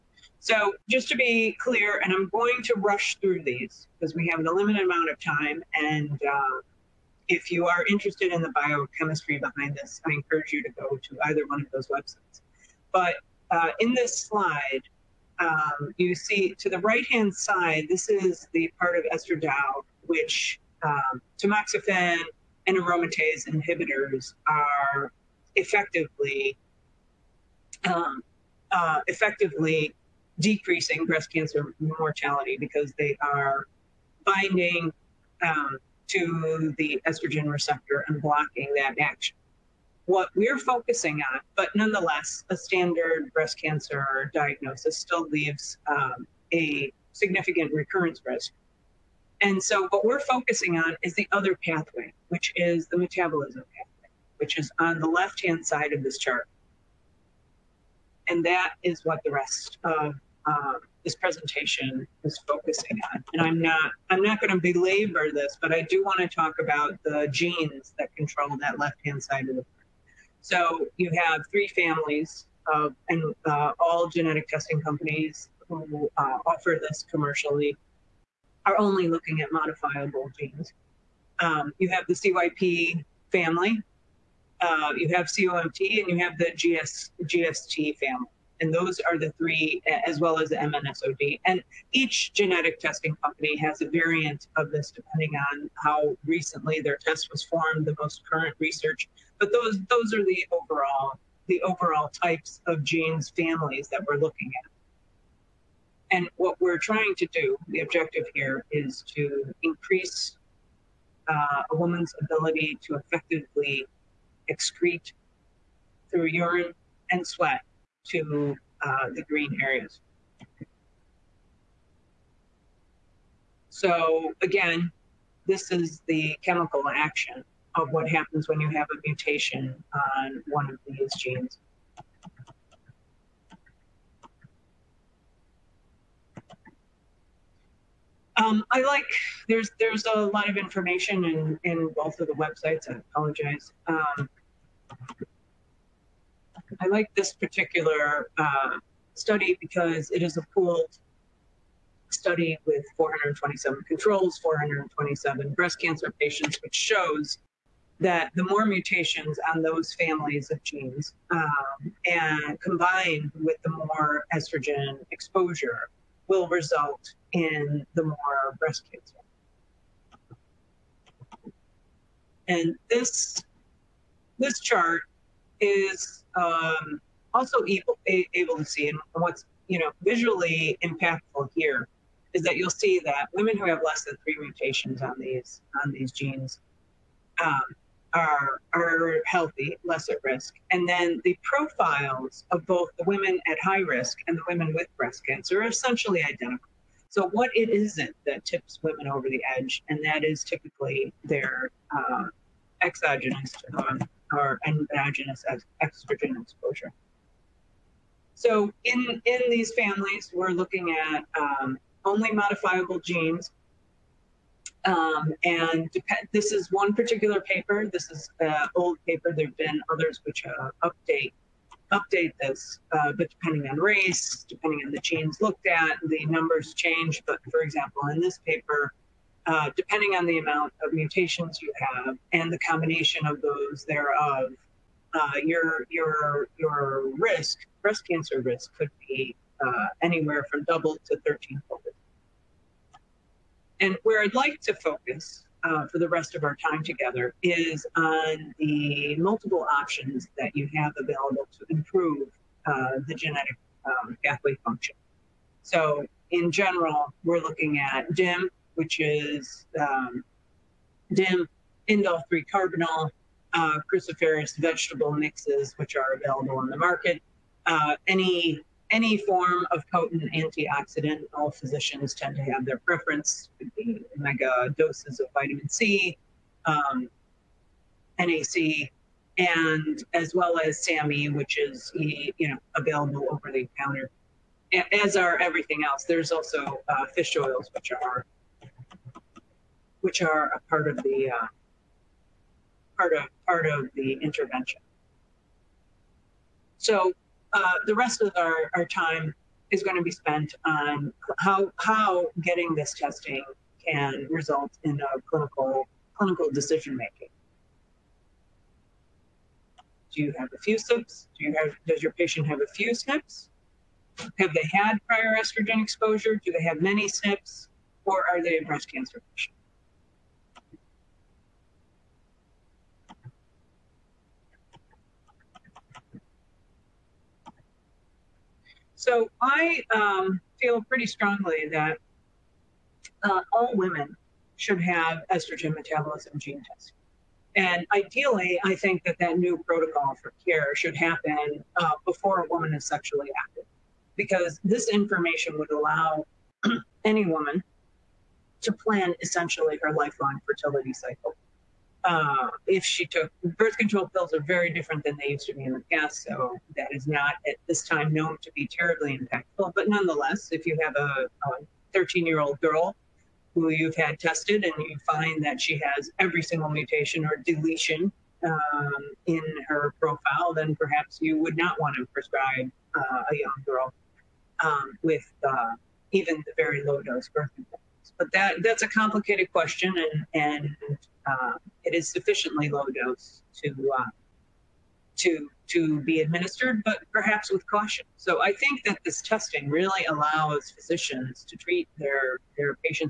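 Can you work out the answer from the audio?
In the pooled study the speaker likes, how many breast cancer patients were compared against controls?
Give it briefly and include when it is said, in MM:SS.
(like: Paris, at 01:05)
427, at 02:34.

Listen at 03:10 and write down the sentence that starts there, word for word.
And then the profiles of both the women at high risk and the women with breast cancer are essentially identical.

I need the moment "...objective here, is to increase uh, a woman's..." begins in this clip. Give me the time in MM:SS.
01:47.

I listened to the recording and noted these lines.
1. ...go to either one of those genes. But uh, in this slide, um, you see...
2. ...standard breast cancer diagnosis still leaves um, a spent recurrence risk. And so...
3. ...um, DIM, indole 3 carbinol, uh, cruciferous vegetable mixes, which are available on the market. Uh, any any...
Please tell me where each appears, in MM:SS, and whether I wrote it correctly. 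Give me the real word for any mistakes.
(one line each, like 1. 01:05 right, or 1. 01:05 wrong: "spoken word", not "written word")
1. 00:10 wrong: "websites", not "genes"
2. 00:42 wrong: "significant", not "spent"
3. 04:19 right.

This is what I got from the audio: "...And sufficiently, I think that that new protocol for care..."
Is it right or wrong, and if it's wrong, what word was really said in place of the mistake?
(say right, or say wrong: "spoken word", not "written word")
wrong: "ideally", not "sufficiently".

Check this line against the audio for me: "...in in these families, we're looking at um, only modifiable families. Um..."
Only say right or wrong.
wrong.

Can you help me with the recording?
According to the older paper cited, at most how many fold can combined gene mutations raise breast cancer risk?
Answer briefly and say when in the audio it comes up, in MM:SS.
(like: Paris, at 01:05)
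13 fold, at 04:01.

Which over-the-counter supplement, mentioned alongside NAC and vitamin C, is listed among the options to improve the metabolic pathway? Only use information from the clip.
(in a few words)
SAMe.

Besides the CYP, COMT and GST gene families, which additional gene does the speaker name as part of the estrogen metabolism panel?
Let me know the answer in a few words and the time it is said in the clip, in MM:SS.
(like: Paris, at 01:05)
MNSOD, at 01:30.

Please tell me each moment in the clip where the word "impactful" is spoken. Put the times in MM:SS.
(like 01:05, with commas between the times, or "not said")
03:00, 05:59.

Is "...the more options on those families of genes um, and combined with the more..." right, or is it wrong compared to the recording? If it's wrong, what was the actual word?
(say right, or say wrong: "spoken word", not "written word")
wrong: "mutations", not "options".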